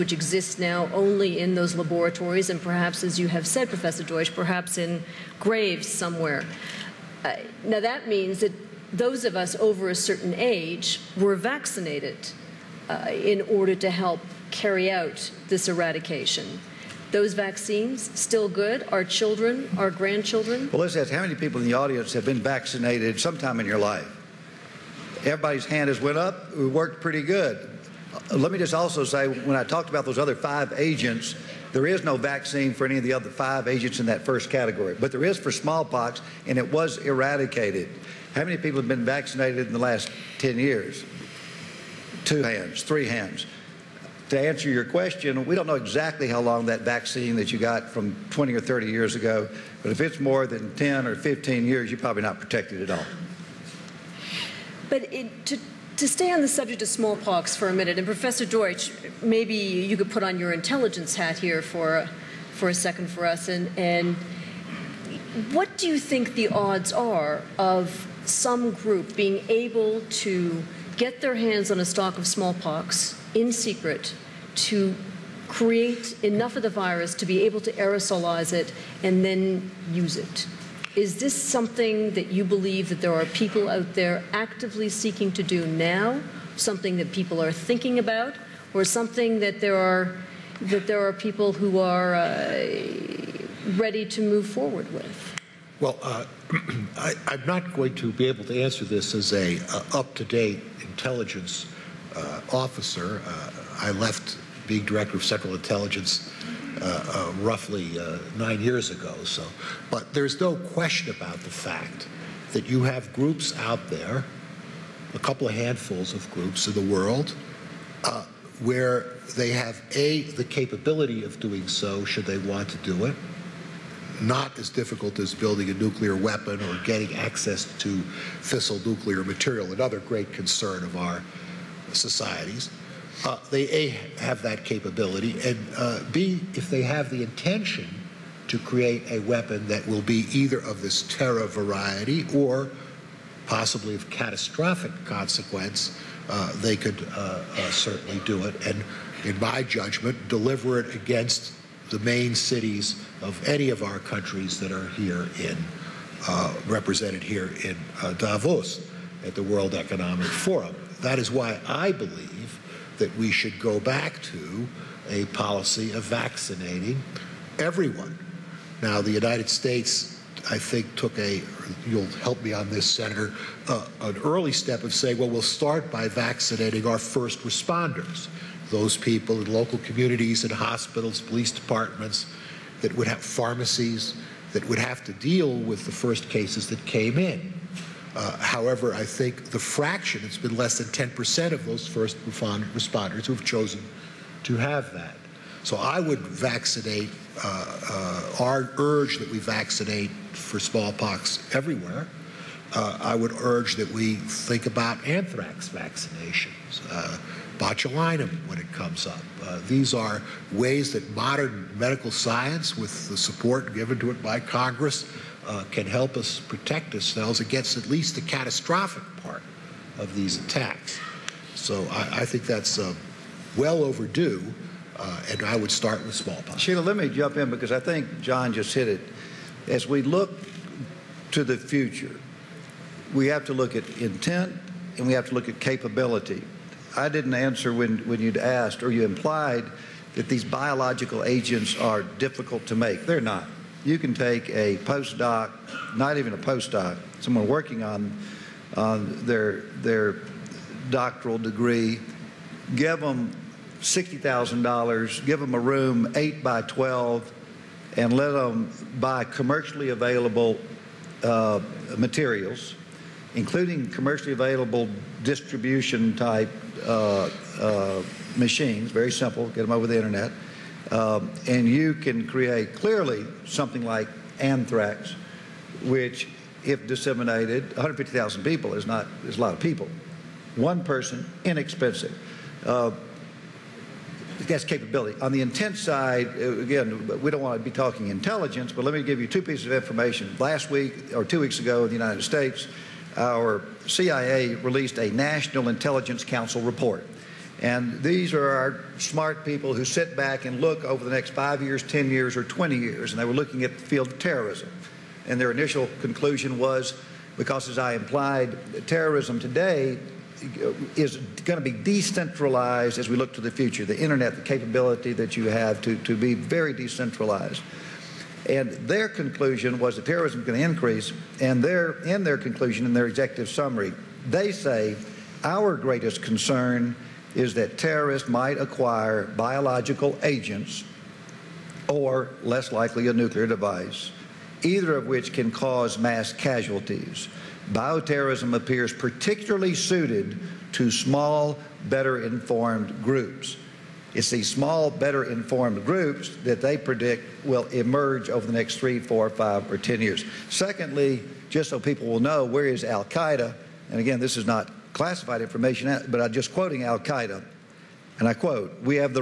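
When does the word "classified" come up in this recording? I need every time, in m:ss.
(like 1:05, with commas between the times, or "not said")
5:54.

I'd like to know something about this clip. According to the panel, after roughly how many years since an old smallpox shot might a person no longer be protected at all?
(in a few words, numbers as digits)
10 or 15 years.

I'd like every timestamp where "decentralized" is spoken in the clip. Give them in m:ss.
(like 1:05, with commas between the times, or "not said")
5:11, 5:16.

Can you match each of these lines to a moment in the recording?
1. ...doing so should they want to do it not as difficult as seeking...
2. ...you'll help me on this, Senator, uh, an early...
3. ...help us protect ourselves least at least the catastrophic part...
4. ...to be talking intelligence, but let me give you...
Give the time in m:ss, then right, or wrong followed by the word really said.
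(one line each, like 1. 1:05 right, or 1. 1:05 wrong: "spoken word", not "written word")
1. 2:01 wrong: "building", not "seeking"
2. 2:51 right
3. 3:35 wrong: "against", not "least"
4. 4:47 right.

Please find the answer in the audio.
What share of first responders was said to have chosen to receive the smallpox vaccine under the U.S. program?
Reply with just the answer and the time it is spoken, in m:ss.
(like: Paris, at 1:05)
less than 10%, at 3:10.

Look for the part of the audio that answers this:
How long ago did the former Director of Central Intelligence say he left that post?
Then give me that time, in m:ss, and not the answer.
1:48.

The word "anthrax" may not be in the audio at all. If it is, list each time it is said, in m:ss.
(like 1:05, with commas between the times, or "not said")
3:25, 4:34.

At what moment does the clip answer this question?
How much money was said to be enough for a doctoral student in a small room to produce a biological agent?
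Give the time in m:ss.
4:13.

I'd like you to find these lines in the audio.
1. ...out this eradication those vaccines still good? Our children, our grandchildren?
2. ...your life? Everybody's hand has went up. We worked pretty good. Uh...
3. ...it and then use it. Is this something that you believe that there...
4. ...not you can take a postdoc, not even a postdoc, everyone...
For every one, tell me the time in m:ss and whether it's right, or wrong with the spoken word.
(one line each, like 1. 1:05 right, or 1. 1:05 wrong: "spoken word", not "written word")
1. 0:14 right
2. 0:23 right
3. 1:18 right
4. 4:03 wrong: "someone", not "everyone".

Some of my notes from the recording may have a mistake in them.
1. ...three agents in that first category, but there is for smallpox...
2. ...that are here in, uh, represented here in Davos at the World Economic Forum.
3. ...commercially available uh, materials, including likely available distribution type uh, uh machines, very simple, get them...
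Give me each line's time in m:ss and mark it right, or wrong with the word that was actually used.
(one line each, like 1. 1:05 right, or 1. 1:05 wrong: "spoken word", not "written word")
1. 0:33 wrong: "five", not "three"
2. 2:34 right
3. 4:19 wrong: "commercially", not "likely".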